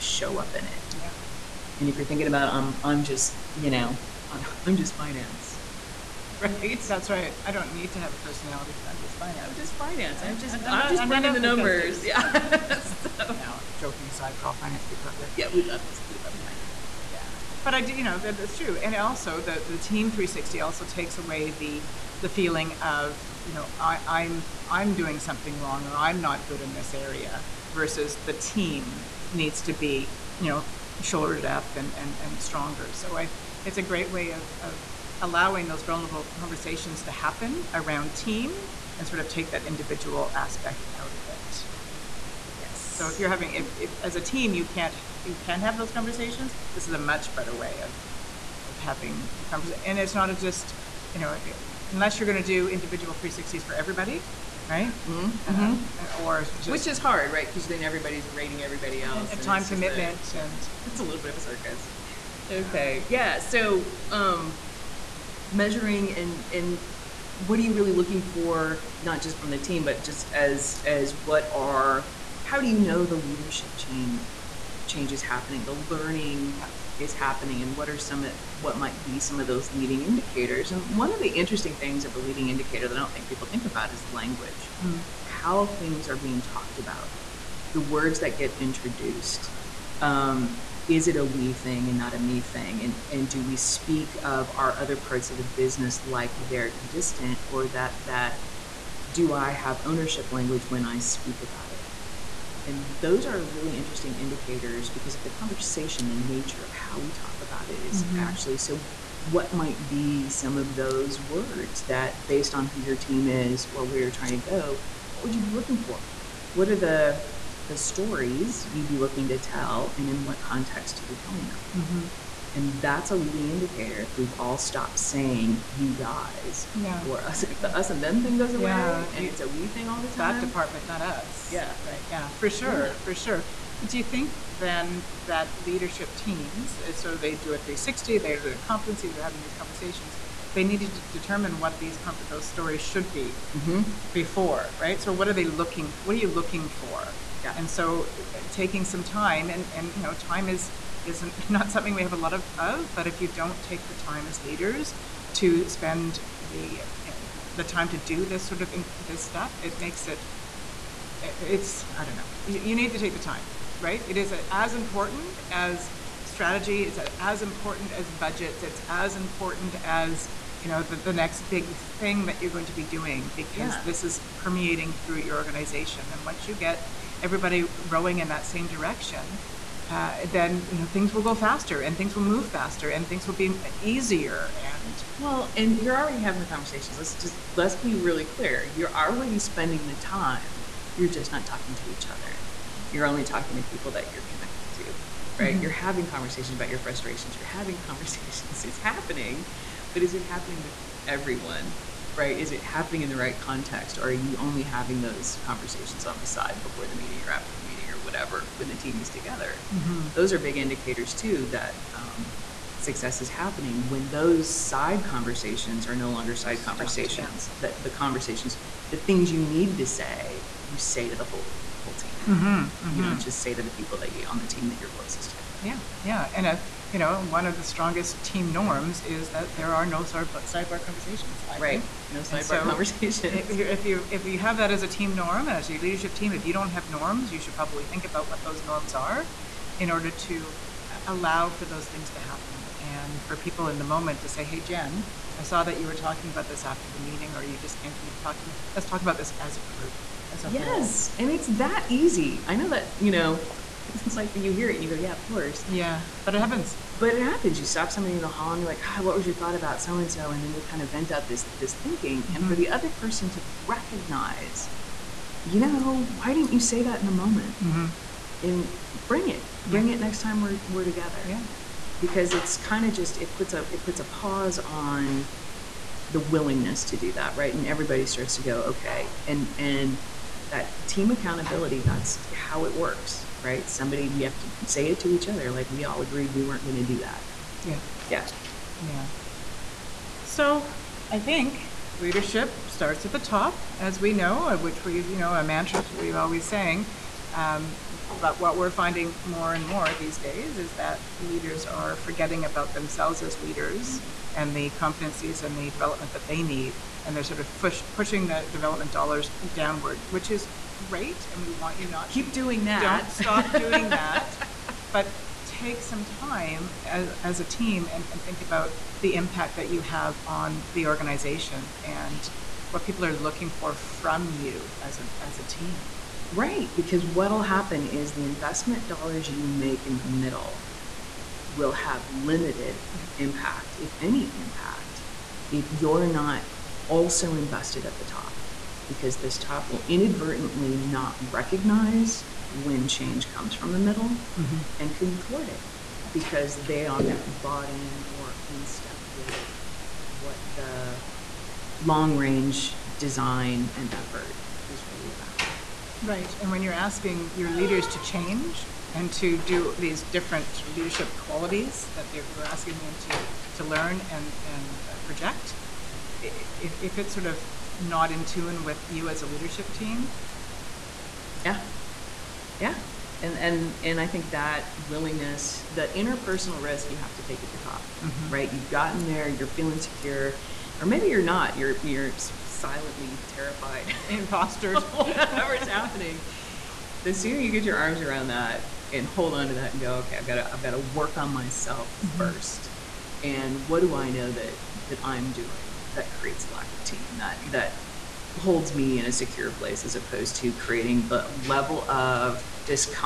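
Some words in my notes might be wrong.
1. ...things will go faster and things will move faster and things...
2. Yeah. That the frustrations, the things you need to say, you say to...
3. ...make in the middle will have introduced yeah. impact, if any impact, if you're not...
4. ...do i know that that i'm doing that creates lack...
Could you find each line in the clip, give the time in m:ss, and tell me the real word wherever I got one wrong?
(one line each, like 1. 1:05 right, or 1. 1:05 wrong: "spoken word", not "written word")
1. 3:00 right
2. 3:37 wrong: "conversations", not "frustrations"
3. 5:29 wrong: "limited", not "introduced"
4. 6:33 right.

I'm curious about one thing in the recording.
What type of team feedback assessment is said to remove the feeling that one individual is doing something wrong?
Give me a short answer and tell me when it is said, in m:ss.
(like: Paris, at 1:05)
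team 360, at 0:19.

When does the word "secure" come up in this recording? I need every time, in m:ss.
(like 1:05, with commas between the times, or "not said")
6:19, 6:39.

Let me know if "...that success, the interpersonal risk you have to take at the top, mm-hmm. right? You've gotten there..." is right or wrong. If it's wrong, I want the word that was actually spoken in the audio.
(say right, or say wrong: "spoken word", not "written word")
wrong: "willingness", not "success".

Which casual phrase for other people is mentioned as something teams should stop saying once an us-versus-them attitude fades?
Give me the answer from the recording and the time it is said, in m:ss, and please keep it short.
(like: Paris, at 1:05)
you guys, at 2:05.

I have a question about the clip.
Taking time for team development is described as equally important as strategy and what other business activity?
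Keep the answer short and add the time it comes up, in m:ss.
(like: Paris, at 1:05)
budgets, at 2:48.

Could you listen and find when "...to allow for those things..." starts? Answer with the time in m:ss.
4:00.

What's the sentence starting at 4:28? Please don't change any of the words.
and bring it bring it next time we're we're together.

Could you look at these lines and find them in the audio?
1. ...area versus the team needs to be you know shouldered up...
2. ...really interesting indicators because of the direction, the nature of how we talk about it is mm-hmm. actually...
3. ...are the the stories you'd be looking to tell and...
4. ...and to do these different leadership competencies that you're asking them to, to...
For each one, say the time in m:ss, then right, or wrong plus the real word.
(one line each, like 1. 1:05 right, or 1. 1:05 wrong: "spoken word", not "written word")
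1. 0:26 right
2. 1:43 wrong: "conversation", not "direction"
3. 1:56 right
4. 5:58 wrong: "qualities", not "competencies".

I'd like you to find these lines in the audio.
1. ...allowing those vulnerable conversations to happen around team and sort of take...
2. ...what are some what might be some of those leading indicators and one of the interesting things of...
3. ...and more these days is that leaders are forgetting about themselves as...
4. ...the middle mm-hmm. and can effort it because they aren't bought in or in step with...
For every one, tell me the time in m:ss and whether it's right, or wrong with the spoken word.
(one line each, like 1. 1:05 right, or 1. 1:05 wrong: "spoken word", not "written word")
1. 0:35 right
2. 1:17 right
3. 4:59 right
4. 5:43 wrong: "thwart", not "effort".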